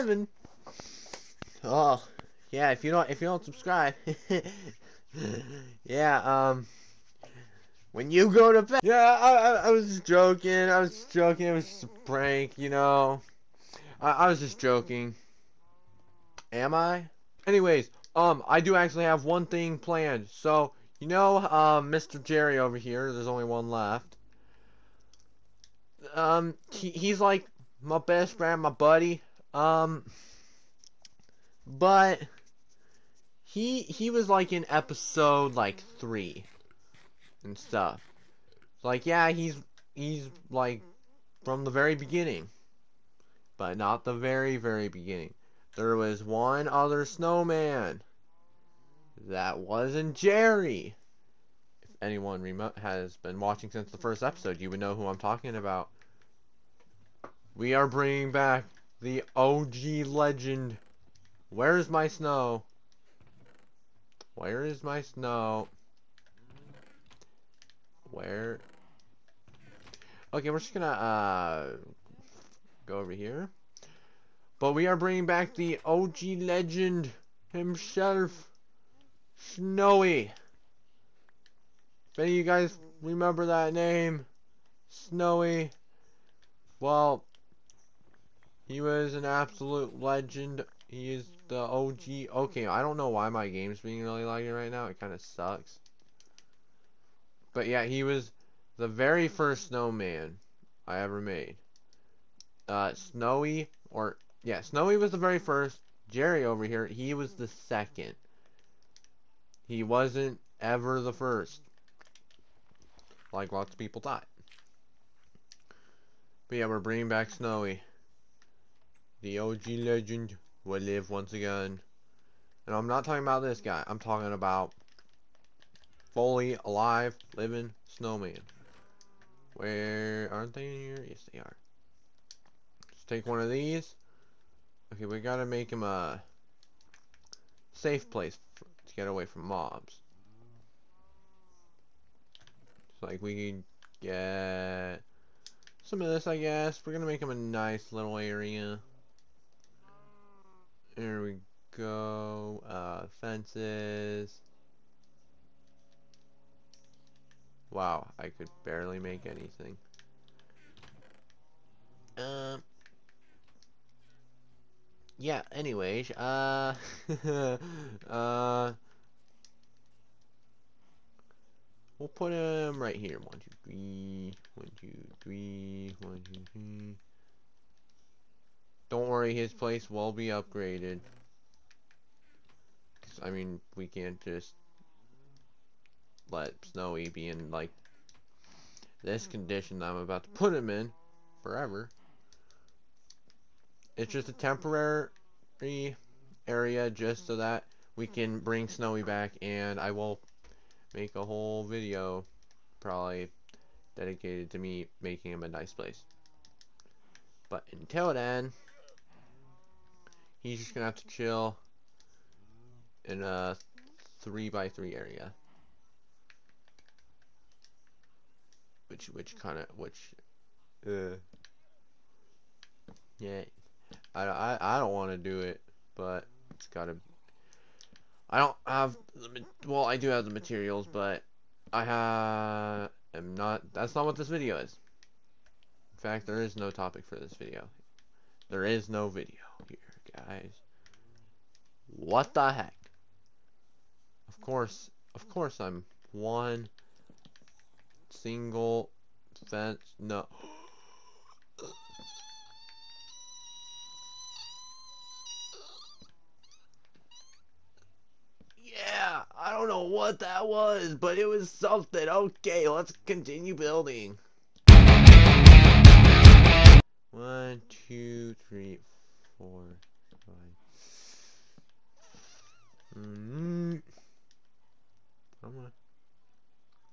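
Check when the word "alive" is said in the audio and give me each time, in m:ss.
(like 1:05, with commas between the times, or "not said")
2:06.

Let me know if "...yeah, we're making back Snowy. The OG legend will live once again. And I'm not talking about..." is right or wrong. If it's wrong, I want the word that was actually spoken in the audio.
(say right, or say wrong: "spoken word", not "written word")
wrong: "bringing", not "making".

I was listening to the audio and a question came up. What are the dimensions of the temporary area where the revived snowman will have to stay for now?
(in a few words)
3 by 3.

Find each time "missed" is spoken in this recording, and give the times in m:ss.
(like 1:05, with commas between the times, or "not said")
not said.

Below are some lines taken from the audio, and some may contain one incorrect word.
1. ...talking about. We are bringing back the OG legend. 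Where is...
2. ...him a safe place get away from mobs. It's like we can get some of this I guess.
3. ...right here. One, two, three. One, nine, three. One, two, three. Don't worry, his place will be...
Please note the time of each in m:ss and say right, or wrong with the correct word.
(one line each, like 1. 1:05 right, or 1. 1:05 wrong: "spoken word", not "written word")
1. 0:55 right
2. 2:15 right
3. 2:52 wrong: "two", not "nine".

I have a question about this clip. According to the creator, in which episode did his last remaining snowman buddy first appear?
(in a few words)
3.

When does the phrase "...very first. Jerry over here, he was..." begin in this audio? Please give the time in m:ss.
1:45.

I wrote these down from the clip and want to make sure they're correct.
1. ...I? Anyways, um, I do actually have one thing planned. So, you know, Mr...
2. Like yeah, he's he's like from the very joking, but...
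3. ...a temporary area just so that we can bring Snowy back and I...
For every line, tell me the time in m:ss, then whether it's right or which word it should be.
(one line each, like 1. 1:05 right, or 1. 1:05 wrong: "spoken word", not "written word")
1. 0:16 right
2. 0:38 wrong: "beginning", not "joking"
3. 3:14 right.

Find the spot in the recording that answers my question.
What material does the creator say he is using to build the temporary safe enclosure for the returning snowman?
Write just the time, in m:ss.
2:33.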